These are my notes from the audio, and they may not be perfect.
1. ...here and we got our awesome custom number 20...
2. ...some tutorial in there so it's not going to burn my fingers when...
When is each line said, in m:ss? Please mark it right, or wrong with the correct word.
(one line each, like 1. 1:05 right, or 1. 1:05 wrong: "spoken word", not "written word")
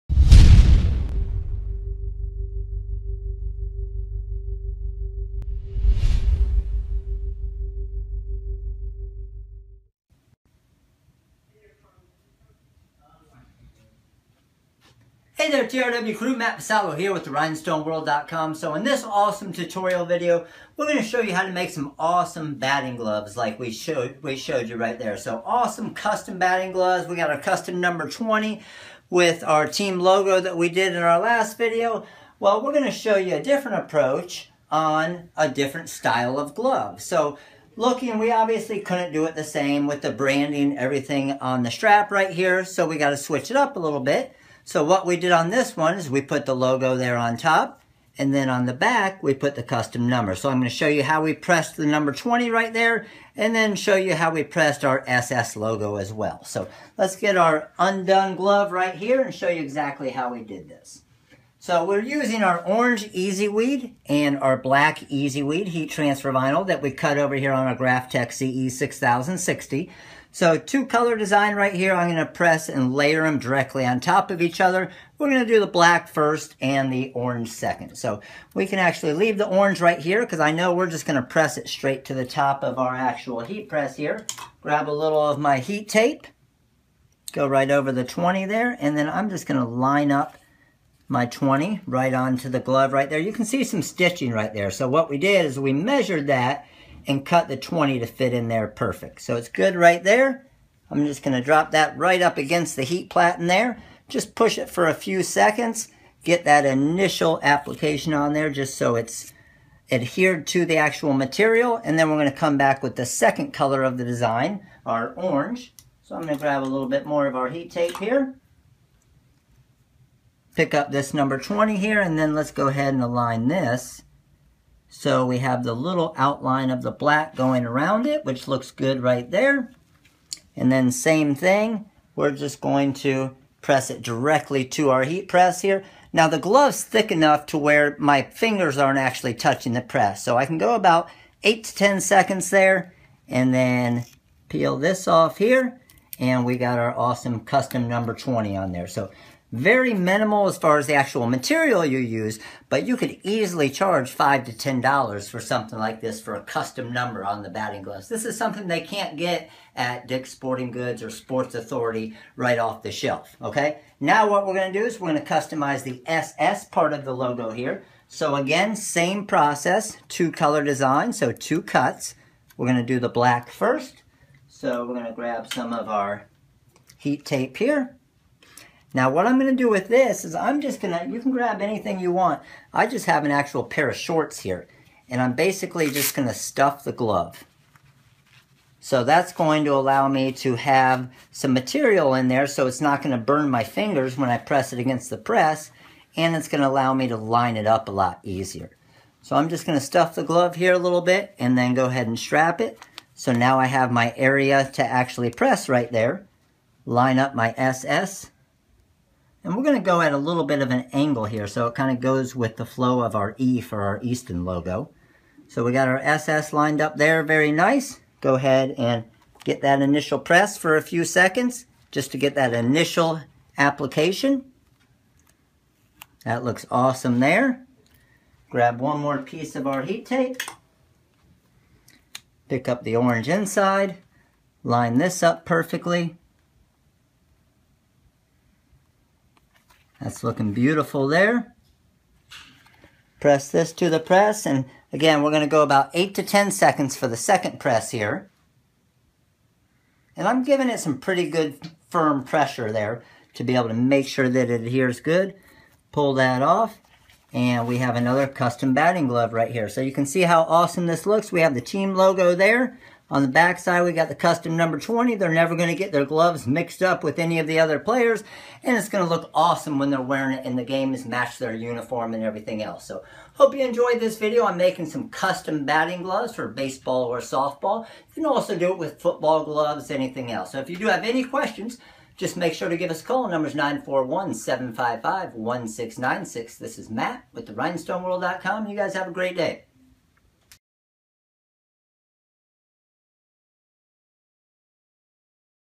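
1. 2:25 right
2. 3:11 wrong: "material", not "tutorial".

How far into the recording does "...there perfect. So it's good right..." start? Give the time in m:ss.
1:38.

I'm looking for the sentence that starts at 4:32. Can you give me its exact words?
So hope you enjoyed this video.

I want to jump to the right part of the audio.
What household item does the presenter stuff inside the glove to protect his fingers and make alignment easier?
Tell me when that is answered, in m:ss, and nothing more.
3:03.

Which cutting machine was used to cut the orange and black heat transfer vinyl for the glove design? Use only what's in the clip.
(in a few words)
Graphtec CE6060.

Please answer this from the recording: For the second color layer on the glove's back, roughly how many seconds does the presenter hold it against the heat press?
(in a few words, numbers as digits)
8 to 10 seconds.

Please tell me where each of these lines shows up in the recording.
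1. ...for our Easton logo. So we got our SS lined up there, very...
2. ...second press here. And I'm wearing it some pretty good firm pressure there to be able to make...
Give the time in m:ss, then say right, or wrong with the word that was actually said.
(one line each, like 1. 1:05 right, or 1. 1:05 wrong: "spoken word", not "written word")
1. 3:33 right
2. 4:07 wrong: "giving", not "wearing".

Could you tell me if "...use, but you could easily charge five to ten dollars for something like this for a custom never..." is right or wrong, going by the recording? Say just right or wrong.
wrong.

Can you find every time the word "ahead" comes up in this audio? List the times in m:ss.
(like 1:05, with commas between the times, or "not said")
2:02, 3:21, 3:38.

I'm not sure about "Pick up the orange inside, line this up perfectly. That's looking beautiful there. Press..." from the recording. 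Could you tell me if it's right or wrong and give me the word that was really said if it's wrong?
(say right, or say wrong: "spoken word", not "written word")
right.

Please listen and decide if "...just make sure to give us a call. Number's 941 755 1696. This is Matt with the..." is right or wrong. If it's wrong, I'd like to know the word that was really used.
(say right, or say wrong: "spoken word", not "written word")
right.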